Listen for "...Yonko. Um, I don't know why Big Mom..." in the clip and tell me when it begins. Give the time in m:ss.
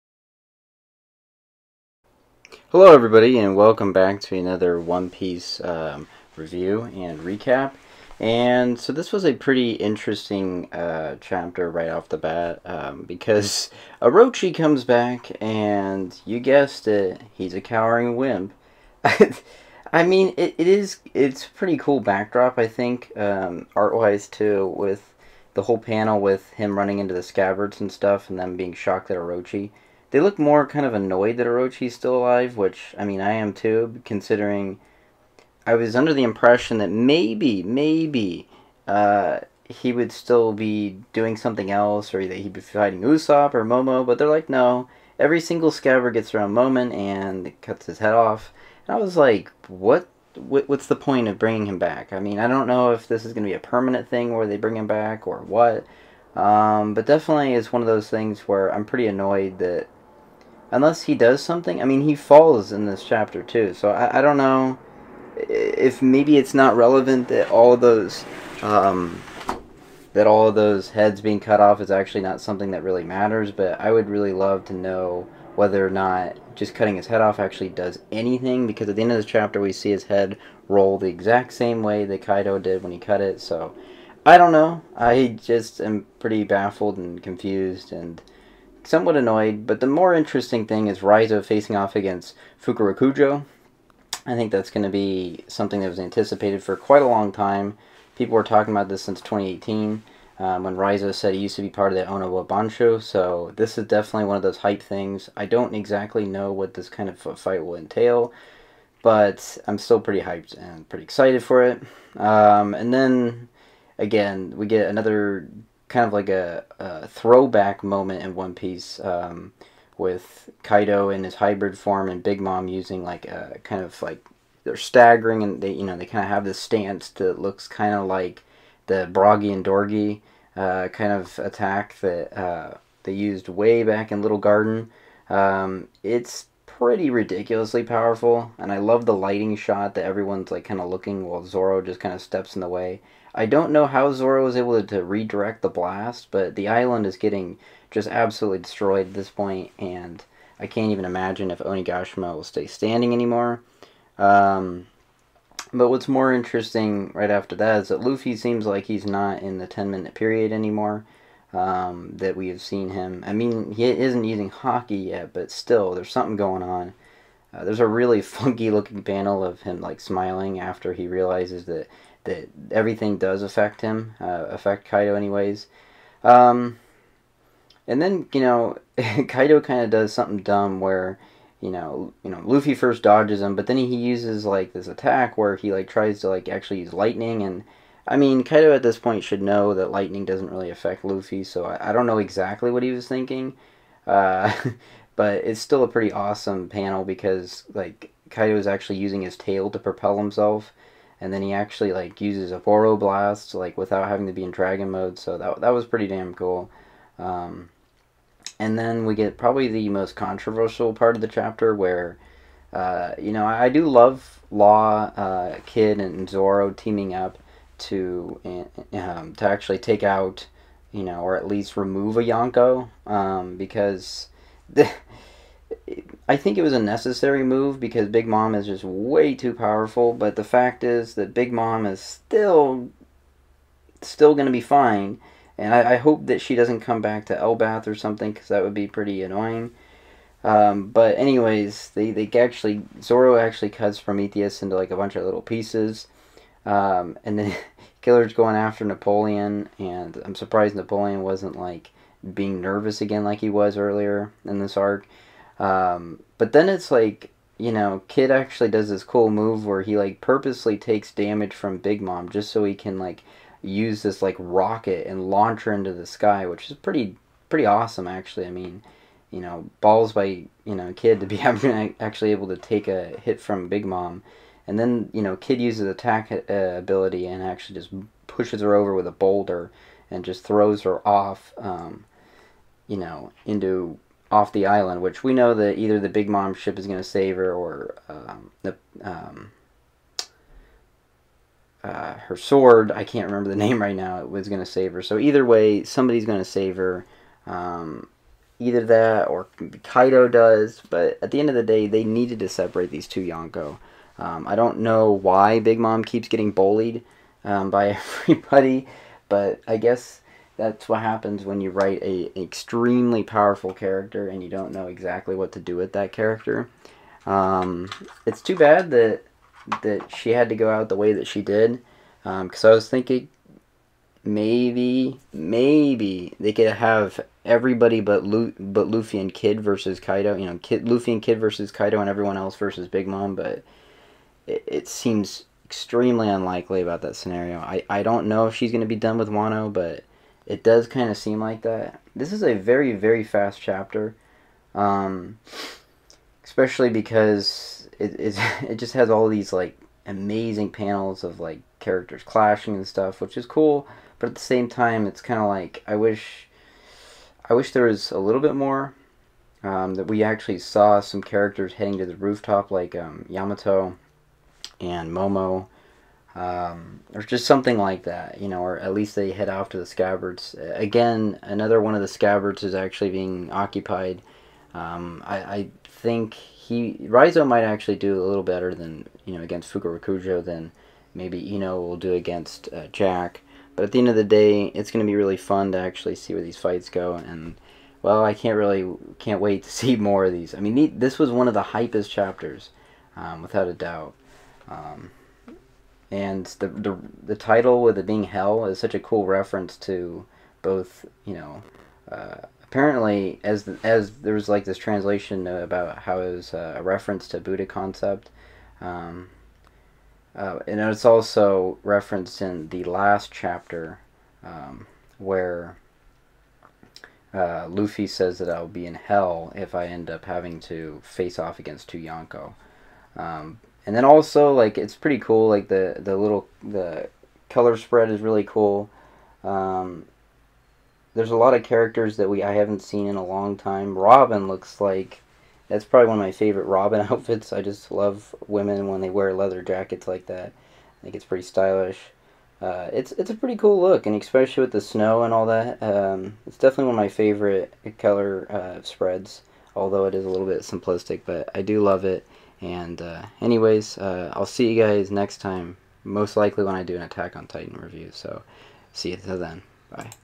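5:03.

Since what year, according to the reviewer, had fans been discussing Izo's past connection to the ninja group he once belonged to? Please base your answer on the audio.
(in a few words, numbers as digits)
2018.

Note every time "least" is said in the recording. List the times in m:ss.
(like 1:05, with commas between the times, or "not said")
3:41, 6:08.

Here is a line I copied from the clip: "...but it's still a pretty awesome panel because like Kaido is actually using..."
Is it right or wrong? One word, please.
right.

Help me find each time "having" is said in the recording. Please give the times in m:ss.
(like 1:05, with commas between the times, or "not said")
3:24, 7:00.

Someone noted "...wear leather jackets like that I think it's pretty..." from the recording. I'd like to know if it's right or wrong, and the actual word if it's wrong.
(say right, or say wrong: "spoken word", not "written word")
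right.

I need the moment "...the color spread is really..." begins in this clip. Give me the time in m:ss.
7:06.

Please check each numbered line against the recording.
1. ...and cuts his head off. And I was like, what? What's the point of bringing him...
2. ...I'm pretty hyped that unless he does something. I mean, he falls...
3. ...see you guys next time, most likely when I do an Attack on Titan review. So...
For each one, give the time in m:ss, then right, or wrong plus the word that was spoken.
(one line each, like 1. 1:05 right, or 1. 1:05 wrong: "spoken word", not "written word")
1. 0:46 right
2. 0:58 wrong: "annoyed", not "hyped"
3. 7:34 right.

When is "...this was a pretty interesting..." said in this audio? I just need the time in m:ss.
0:08.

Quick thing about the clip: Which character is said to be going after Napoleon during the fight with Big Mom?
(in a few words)
Killer.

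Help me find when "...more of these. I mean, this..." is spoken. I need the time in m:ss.
6:29.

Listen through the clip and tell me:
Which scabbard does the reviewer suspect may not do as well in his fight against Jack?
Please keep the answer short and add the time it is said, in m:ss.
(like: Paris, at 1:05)
Eno, at 6:21.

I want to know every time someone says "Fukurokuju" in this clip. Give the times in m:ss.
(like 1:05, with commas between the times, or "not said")
1:32, 6:19.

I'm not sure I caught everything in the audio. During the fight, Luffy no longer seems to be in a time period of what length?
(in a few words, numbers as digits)
10 minutes.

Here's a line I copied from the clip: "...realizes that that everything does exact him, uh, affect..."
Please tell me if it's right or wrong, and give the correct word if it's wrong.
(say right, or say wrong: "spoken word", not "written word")
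wrong: "affect", not "exact".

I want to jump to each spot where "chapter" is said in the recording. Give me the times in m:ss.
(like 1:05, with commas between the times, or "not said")
0:11, 1:03, 1:19, 3:31, 5:43, 6:32, 6:53.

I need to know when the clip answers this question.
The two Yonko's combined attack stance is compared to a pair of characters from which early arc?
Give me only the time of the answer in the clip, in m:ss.
2:14.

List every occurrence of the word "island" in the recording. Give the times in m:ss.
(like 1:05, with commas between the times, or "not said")
2:26, 4:44.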